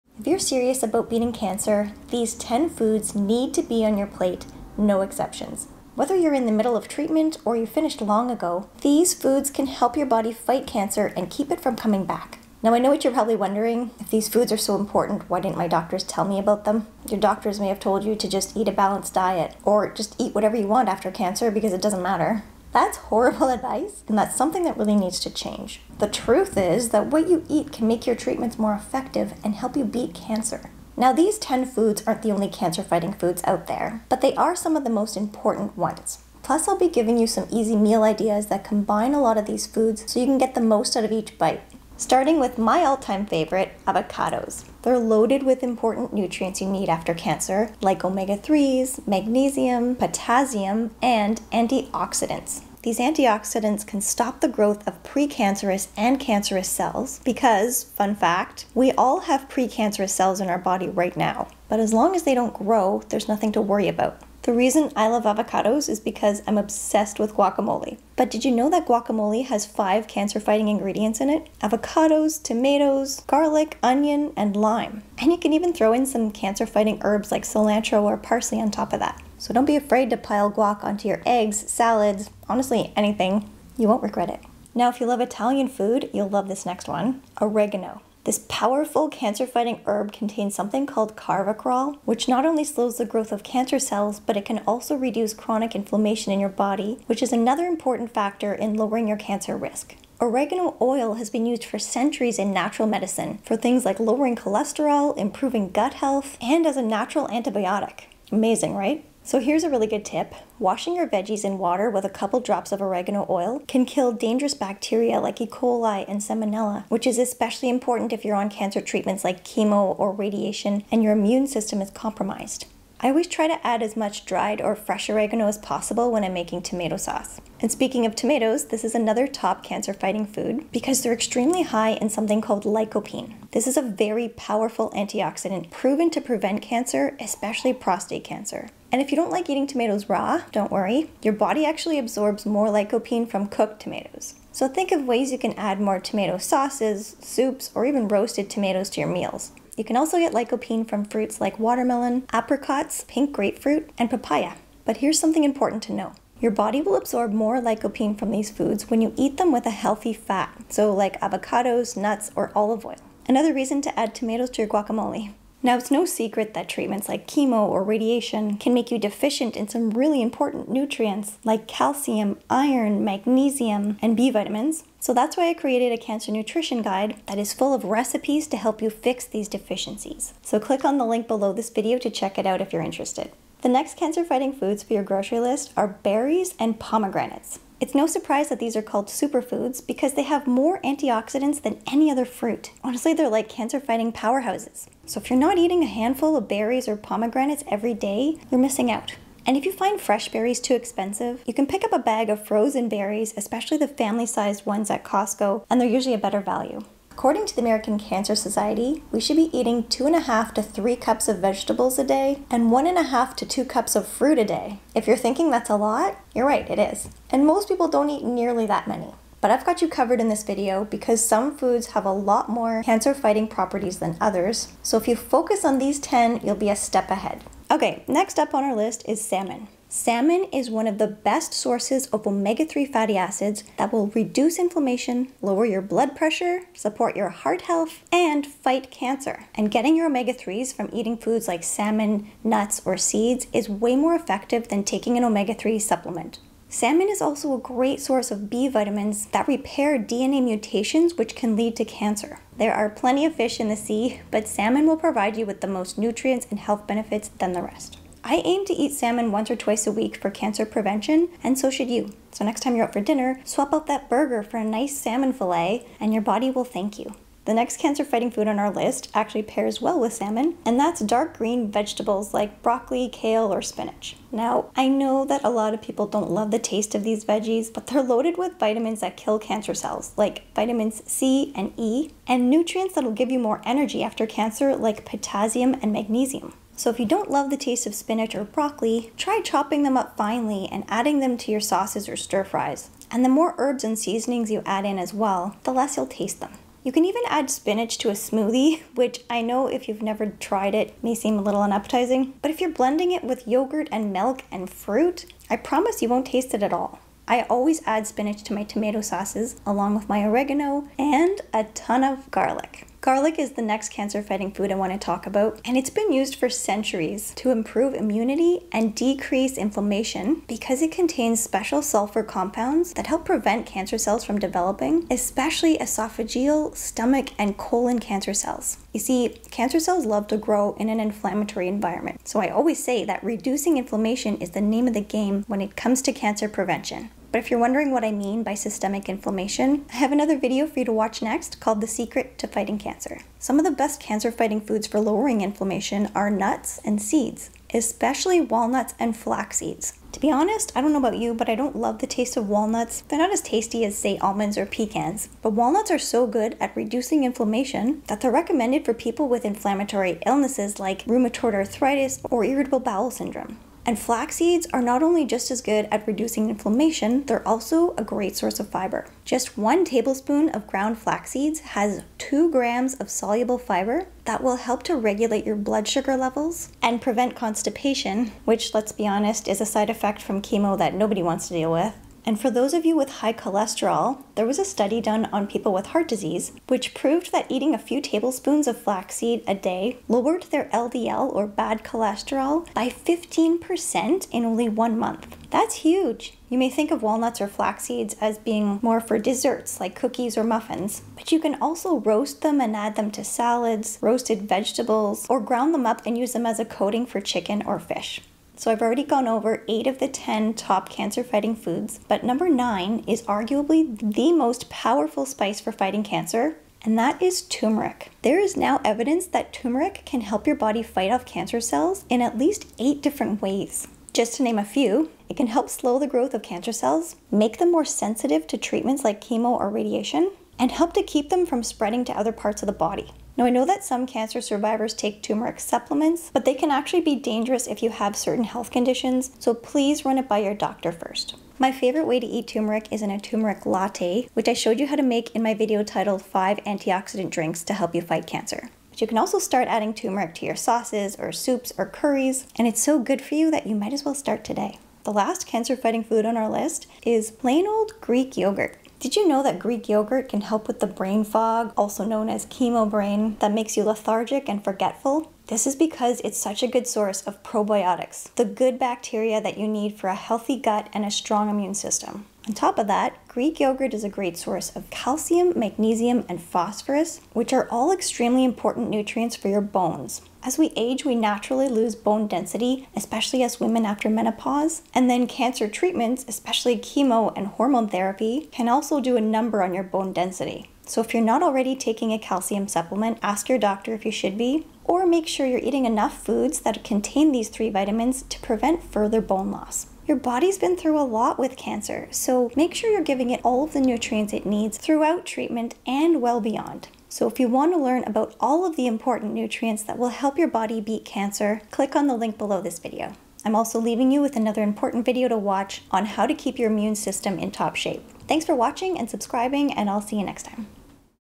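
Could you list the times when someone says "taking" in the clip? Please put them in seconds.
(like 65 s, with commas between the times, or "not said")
244 s, 491 s.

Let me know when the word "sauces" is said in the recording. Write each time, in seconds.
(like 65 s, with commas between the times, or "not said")
126 s, 146 s, 291 s, 309 s, 450 s.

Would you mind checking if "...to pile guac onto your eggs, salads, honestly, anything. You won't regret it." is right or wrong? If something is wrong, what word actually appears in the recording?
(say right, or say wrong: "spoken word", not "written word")
right.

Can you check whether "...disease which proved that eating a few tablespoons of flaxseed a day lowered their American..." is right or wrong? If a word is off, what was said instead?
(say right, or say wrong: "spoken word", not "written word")
wrong: "LDL", not "American".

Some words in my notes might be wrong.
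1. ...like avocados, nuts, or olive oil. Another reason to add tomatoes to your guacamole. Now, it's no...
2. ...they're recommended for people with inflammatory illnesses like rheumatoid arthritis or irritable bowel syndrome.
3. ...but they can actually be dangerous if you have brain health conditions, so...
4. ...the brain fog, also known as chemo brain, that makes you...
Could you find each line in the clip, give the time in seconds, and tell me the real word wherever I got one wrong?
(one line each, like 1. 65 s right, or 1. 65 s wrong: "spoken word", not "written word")
1. 160 s right
2. 358 s right
3. 436 s wrong: "certain", not "brain"
4. 460 s right.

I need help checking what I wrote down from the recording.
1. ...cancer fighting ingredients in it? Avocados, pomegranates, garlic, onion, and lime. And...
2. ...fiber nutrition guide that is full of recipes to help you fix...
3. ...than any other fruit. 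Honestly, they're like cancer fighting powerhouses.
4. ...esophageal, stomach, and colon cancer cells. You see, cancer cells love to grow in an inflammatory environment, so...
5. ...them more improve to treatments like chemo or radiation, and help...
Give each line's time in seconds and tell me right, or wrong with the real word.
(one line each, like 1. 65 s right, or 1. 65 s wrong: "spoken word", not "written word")
1. 70 s wrong: "tomatoes", not "pomegranates"
2. 176 s wrong: "cancer", not "fiber"
3. 191 s right
4. 325 s right
5. 427 s wrong: "sensitive", not "improve".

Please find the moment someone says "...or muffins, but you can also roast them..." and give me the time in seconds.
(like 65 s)
400 s.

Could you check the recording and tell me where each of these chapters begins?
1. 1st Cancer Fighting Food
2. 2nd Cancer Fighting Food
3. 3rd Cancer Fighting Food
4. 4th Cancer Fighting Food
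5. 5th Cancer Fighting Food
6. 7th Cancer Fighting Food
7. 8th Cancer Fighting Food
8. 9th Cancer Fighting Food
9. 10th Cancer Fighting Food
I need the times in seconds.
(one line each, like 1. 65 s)
1. 43 s
2. 87 s
3. 129 s
4. 187 s
5. 229 s
6. 272 s
7. 312 s
8. 416 s
9. 457 s.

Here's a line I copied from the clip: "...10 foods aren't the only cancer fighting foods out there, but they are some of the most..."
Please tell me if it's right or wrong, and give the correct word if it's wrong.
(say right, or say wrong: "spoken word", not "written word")
right.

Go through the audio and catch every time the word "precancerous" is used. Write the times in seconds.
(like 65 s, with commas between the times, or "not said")
55 s, 59 s.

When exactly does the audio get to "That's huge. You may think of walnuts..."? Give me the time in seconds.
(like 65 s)
395 s.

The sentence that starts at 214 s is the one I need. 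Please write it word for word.
If you're thinking that's a lot, you're right, it is.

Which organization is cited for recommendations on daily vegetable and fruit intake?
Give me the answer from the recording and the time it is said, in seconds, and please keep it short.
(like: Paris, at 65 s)
American Cancer Society, at 207 s.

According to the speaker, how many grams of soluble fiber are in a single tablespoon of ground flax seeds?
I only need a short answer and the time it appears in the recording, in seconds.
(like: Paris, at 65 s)
2, at 372 s.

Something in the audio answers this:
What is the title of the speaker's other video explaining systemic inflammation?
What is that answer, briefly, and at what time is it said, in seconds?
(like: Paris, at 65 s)
The Secret to Fighting Cancer, at 341 s.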